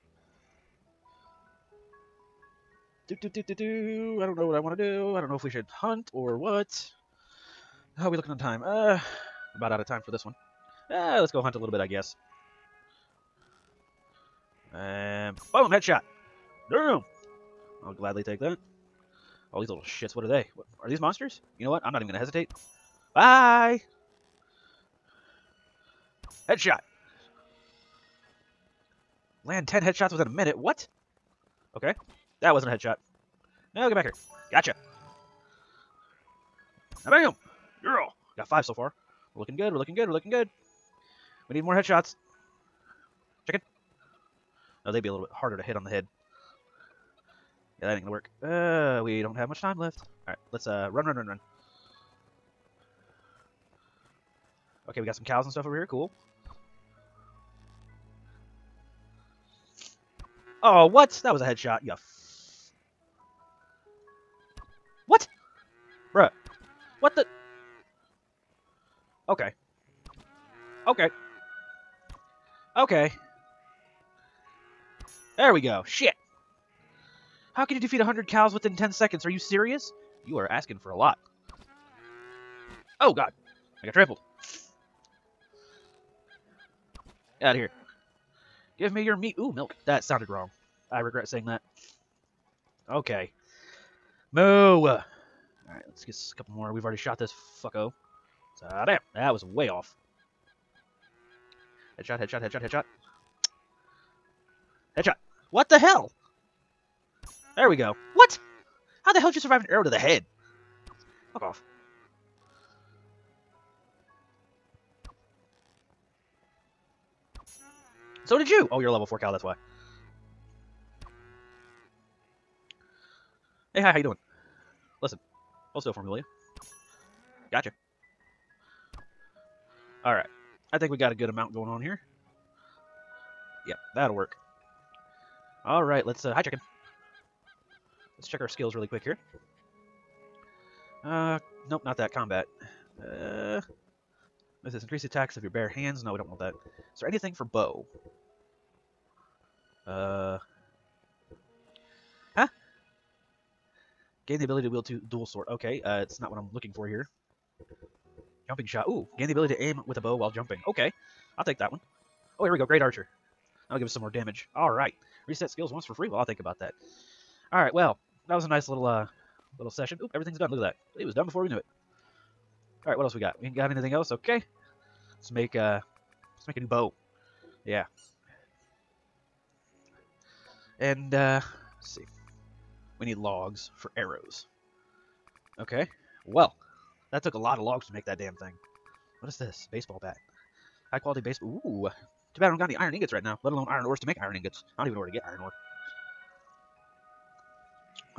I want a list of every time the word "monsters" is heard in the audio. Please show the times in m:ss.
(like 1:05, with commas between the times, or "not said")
0:20.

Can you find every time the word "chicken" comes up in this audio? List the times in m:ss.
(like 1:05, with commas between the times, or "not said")
0:43, 2:16.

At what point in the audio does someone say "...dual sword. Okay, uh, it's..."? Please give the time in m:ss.
2:35.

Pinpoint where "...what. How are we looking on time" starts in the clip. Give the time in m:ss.
0:06.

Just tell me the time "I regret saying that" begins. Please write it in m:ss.
1:30.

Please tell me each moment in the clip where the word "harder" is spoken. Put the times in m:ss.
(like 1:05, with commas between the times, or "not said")
0:45.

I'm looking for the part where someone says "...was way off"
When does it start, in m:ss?
1:39.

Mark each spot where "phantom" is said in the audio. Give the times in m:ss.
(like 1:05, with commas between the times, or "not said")
not said.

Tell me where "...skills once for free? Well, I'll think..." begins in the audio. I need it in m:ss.
2:45.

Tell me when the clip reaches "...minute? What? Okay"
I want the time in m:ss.
0:30.